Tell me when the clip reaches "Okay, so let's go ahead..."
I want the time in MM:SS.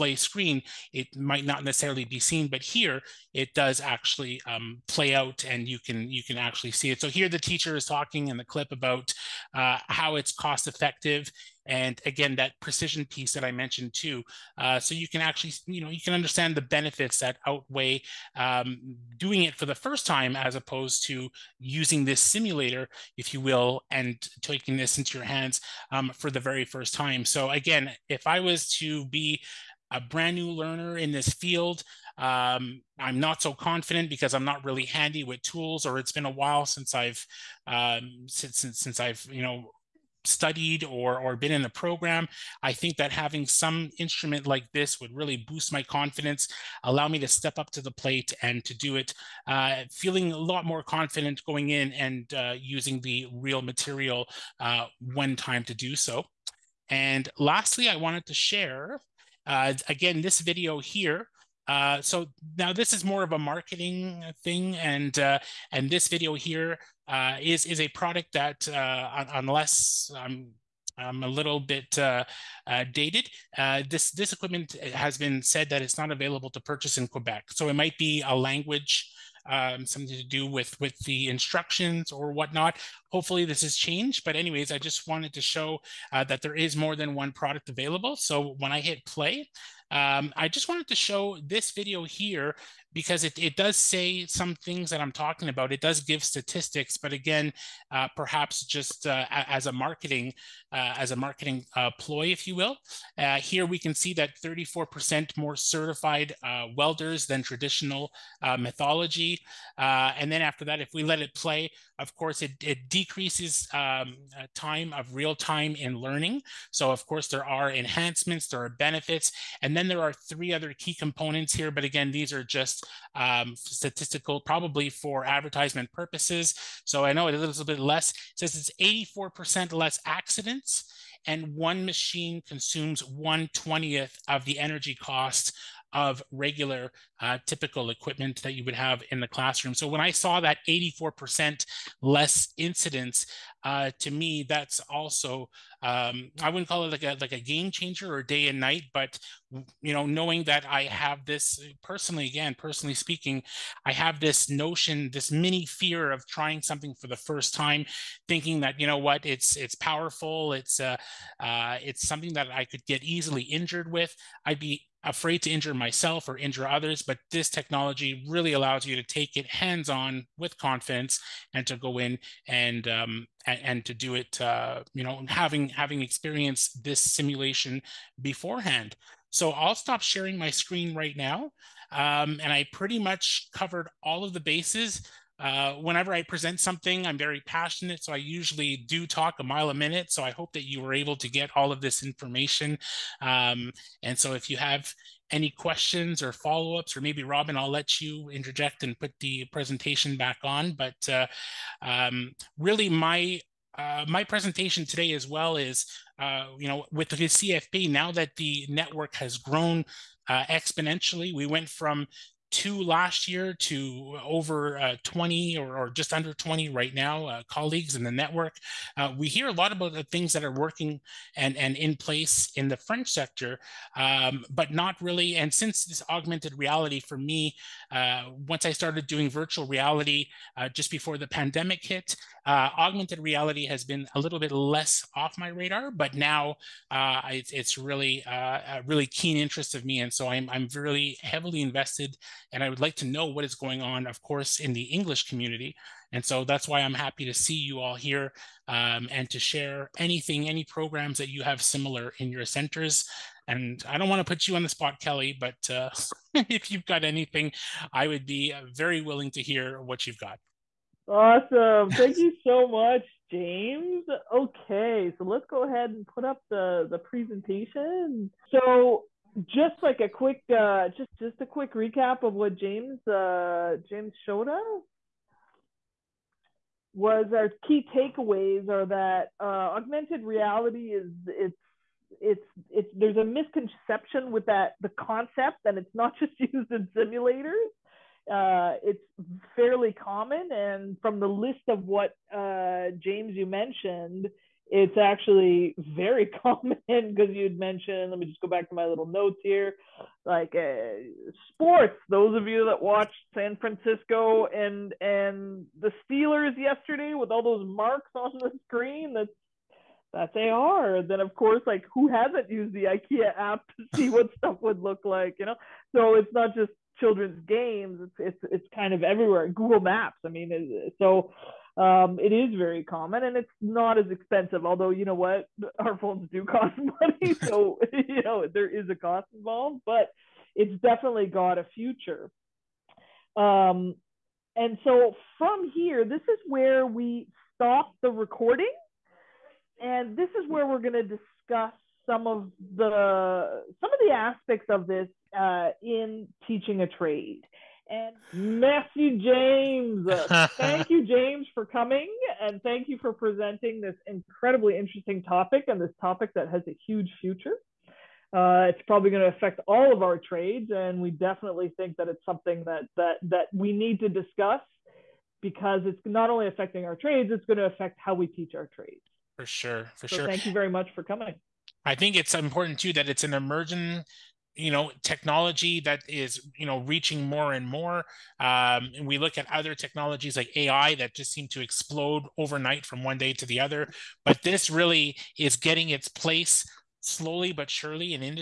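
04:24.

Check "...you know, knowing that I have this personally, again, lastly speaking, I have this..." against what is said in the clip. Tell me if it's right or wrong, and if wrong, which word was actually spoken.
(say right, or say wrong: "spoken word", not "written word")
wrong: "personally", not "lastly".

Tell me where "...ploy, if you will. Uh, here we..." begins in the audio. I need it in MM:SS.
01:41.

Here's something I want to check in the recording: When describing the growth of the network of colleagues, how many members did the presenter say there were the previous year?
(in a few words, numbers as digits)
2.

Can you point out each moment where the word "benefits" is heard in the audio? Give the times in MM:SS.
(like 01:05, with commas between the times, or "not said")
00:16, 01:58.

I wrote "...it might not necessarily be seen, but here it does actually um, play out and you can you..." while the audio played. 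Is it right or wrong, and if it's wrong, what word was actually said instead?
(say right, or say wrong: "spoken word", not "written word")
right.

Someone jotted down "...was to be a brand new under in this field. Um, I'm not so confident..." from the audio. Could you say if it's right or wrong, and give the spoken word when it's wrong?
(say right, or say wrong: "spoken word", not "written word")
wrong: "learner", not "under".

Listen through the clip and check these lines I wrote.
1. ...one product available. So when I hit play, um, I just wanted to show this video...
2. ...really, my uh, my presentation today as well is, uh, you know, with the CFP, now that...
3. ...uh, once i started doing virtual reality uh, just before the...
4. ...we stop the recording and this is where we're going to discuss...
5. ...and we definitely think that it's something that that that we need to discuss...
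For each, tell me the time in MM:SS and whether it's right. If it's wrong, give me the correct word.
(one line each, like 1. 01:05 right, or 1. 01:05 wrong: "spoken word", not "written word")
1. 01:27 right
2. 03:22 right
3. 03:47 right
4. 05:36 right
5. 06:00 right.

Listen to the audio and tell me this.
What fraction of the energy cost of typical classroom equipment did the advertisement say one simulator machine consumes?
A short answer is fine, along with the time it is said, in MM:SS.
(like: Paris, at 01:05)
1/20th, at 02:13.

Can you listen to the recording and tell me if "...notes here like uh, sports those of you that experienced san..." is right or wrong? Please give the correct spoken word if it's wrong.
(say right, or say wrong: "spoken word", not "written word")
wrong: "watched", not "experienced".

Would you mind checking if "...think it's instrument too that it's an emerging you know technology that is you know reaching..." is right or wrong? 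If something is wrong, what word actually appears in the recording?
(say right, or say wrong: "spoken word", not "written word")
wrong: "important", not "instrument".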